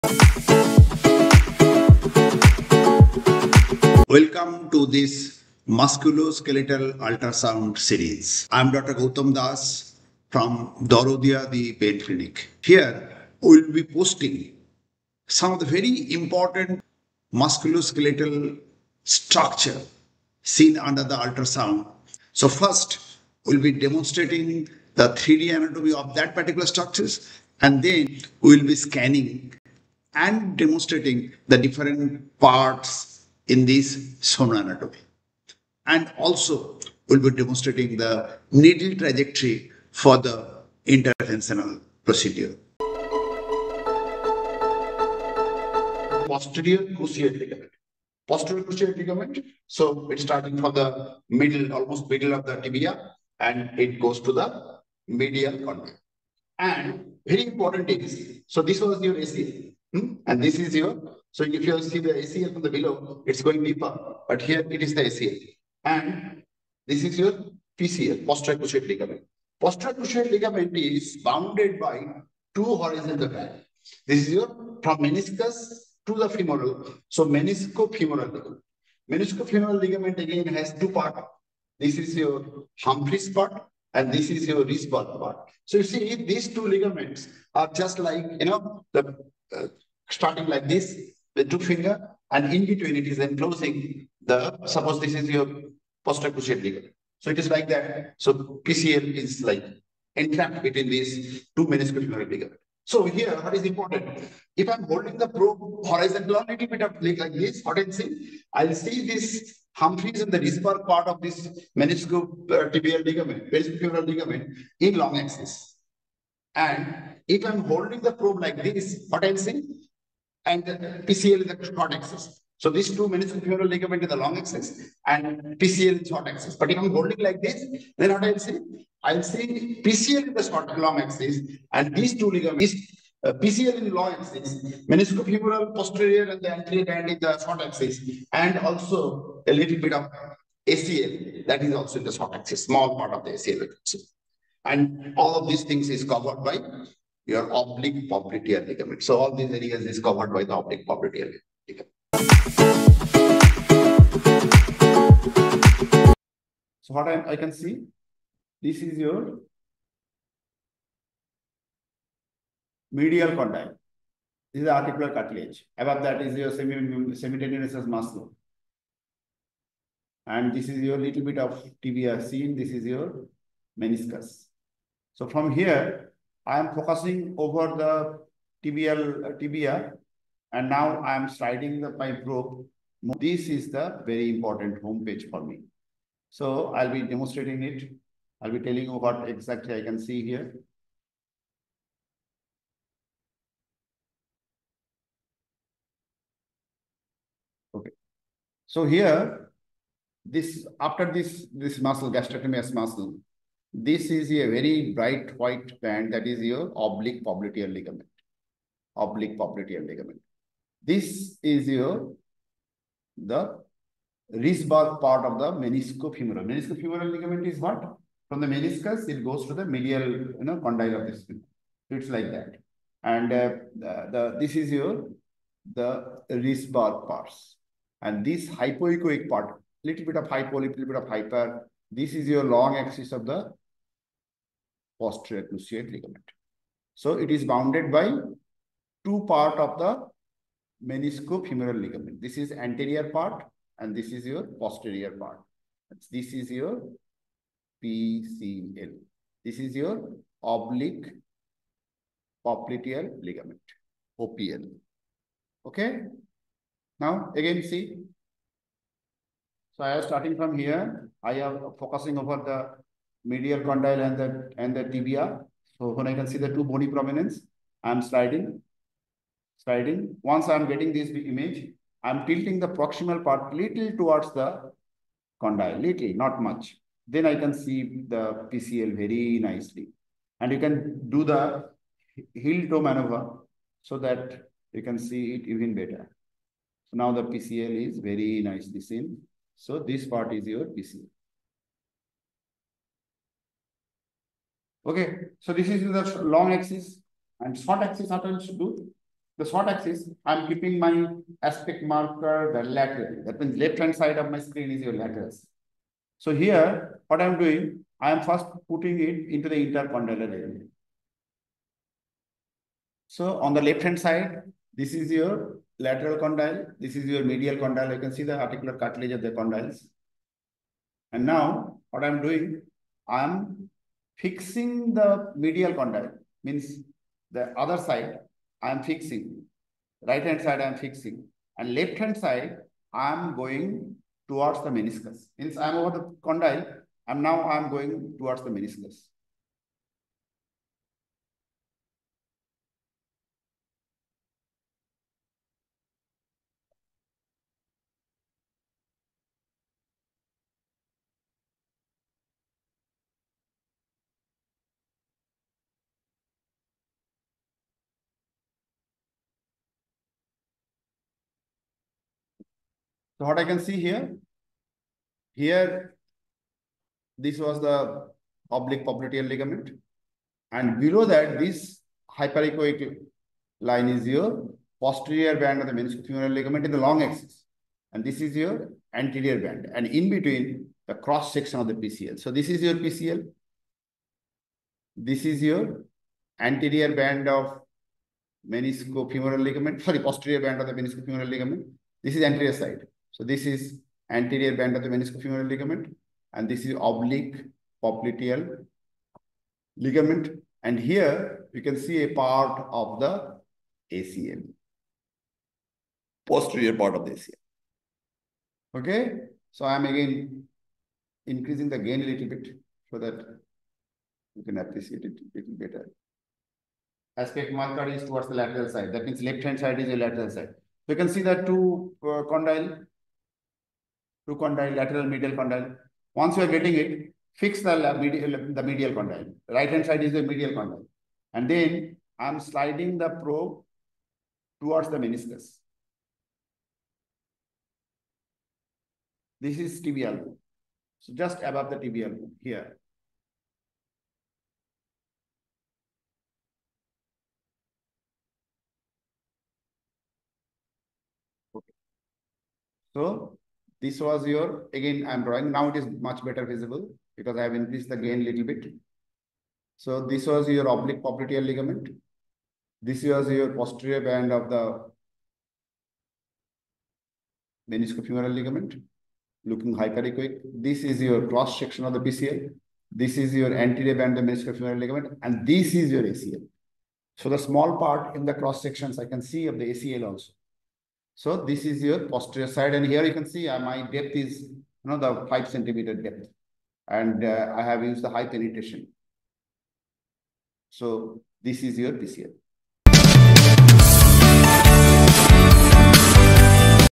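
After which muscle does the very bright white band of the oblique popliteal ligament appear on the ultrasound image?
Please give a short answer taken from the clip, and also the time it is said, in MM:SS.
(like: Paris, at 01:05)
Gastrocnemius, at 03:22.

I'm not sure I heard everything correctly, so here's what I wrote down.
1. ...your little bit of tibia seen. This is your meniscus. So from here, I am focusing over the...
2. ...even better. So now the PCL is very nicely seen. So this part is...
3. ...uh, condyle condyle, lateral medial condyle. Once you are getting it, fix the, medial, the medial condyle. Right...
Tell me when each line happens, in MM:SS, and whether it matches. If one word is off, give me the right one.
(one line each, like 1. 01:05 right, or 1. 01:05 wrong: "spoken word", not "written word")
1. 02:50 right
2. 04:45 right
3. 07:02 right.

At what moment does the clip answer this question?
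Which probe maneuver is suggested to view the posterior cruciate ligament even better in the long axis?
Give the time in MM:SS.
04:42.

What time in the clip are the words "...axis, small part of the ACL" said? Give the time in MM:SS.
02:22.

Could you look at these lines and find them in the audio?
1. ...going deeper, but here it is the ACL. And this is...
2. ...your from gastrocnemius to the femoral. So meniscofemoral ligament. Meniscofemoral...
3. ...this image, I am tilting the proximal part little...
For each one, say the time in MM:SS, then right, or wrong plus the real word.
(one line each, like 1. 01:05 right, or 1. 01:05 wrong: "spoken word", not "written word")
1. 01:03 right
2. 01:14 wrong: "meniscus", not "gastrocnemius"
3. 04:30 right.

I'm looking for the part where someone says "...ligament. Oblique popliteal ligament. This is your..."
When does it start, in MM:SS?
03:27.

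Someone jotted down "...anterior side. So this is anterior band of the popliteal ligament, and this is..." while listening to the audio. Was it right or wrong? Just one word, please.
wrong.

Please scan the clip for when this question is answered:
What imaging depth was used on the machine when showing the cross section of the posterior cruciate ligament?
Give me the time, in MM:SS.
08:05.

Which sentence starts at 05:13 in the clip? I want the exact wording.
So on the left hand side, this is your lateral condyle.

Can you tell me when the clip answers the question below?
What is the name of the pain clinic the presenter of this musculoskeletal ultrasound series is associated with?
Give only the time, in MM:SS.
00:10.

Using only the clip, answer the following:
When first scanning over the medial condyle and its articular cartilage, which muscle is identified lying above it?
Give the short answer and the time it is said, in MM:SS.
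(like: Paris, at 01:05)
Semitendinosus, at 02:46.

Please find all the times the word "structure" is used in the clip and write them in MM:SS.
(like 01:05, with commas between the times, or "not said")
00:19, 00:26.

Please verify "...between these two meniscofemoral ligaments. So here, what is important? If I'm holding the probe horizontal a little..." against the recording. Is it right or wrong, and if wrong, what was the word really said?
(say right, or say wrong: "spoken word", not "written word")
right.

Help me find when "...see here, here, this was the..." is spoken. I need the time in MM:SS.
06:03.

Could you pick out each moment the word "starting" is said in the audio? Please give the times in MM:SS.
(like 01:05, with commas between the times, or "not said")
00:50, 01:30, 04:20.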